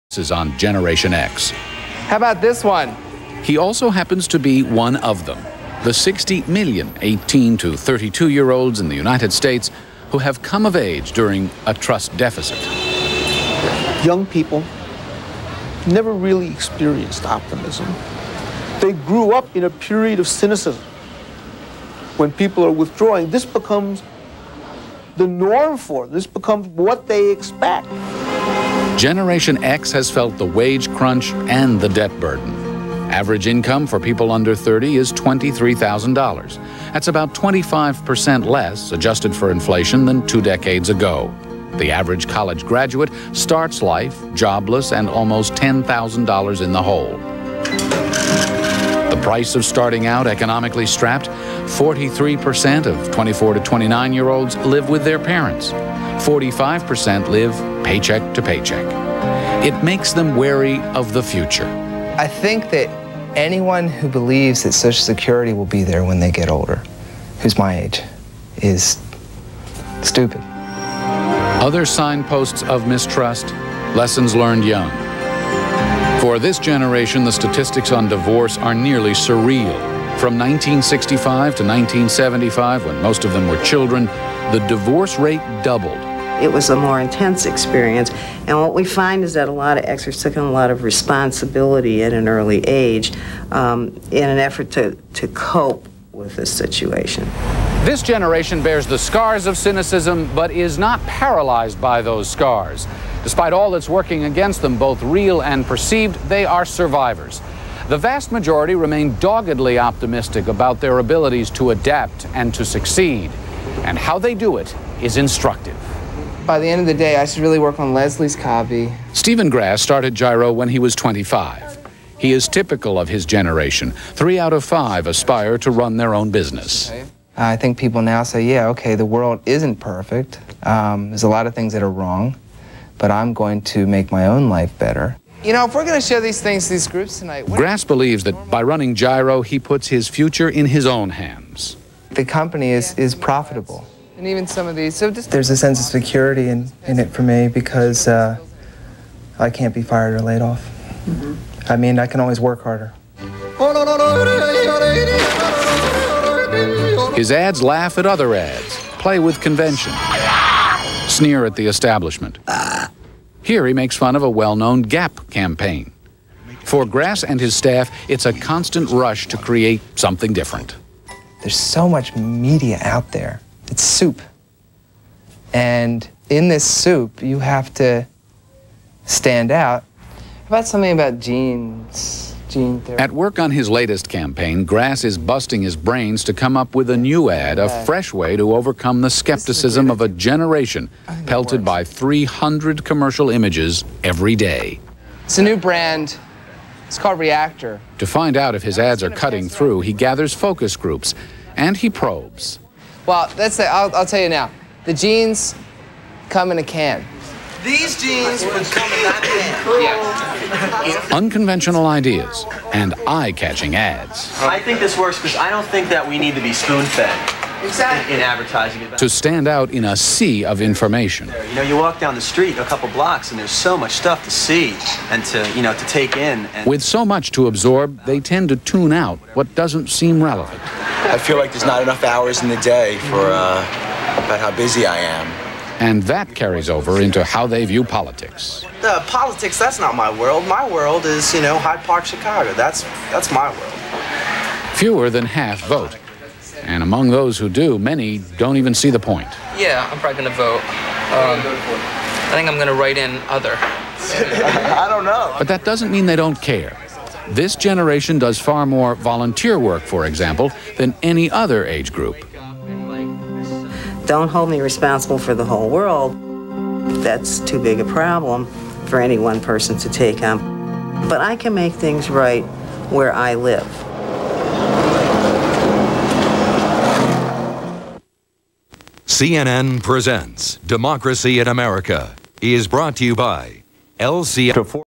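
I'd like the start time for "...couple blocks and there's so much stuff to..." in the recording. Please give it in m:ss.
3:42.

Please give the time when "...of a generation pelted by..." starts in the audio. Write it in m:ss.
3:09.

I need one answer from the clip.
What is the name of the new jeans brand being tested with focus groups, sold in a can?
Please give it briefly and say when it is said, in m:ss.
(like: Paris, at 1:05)
Reactor, at 3:17.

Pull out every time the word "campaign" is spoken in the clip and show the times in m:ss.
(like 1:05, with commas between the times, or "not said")
2:45, 3:04.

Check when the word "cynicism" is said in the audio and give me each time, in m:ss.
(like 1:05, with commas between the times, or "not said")
0:20, 1:39.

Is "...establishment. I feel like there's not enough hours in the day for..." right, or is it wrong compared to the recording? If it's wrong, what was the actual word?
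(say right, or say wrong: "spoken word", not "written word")
wrong: "relevant", not "establishment".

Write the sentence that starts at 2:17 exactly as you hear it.
Grasse believes that by running Gyro, he puts his future in his own hands.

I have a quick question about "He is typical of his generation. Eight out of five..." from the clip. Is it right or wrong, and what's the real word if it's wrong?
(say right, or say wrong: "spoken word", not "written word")
wrong: "Three", not "Eight".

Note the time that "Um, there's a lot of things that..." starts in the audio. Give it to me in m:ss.
2:10.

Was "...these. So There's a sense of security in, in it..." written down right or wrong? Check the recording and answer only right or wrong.
right.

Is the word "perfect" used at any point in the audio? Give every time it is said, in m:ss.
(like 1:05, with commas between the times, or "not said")
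2:09.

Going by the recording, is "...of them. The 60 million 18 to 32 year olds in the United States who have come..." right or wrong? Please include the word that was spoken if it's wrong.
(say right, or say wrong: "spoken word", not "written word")
right.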